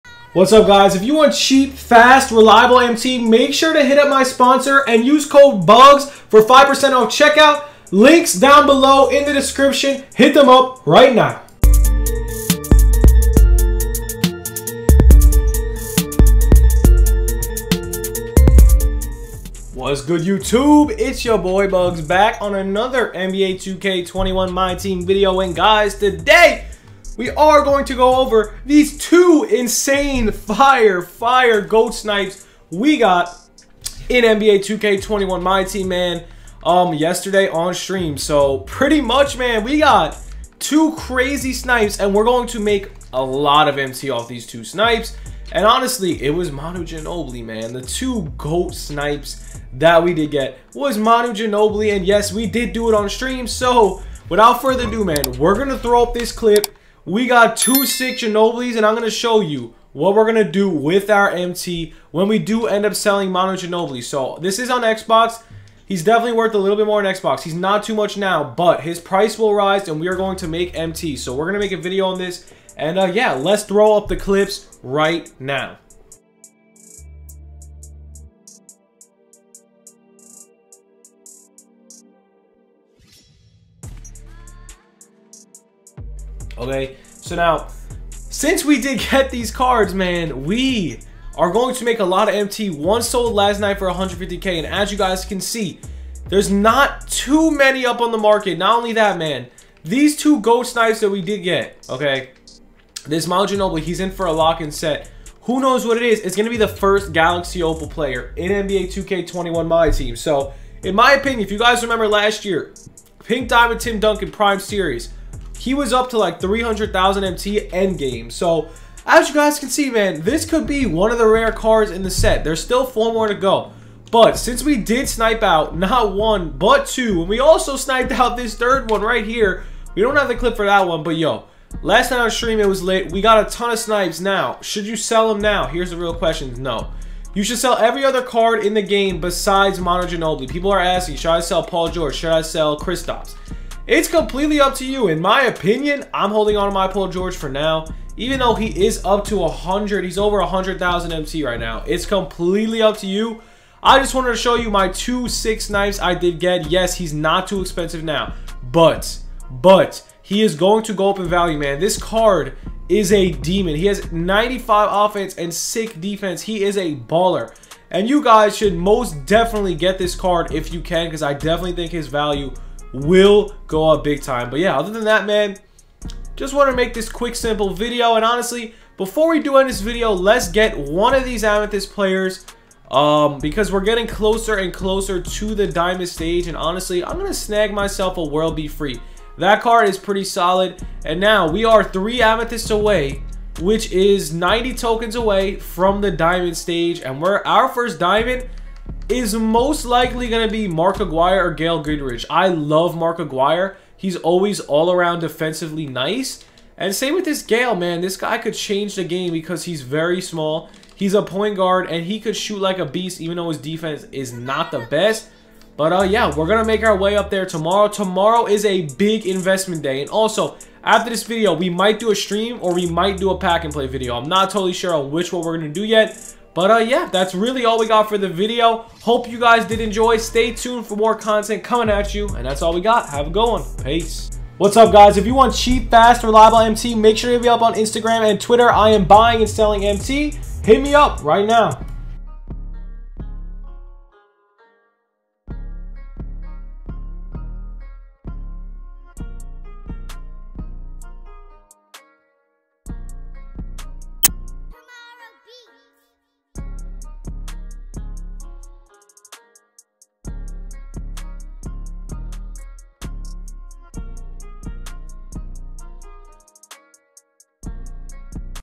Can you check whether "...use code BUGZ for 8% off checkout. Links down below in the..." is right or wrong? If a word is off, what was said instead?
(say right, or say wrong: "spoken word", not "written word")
wrong: "5", not "8".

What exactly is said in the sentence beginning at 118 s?
So as you guys can see, man, this could be one of the rare cards in the set.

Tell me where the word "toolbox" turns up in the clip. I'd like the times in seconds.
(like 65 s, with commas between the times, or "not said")
not said.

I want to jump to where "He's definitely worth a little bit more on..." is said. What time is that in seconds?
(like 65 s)
65 s.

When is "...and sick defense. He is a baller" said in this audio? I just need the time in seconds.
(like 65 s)
165 s.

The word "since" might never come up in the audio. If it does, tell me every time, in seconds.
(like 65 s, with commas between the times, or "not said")
88 s, 124 s.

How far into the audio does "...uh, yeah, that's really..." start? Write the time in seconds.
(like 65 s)
226 s.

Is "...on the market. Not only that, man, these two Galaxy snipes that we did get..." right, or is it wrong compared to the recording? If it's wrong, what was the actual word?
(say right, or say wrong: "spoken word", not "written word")
wrong: "GOAT", not "Galaxy".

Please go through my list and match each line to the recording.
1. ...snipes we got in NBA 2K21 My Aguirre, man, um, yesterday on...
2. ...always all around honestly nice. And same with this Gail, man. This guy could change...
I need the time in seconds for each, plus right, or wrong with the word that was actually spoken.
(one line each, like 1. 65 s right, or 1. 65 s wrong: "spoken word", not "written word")
1. 31 s wrong: "Team", not "Aguirre"
2. 204 s wrong: "defensively", not "honestly".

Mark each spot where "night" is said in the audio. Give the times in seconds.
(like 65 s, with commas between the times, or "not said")
93 s, 132 s.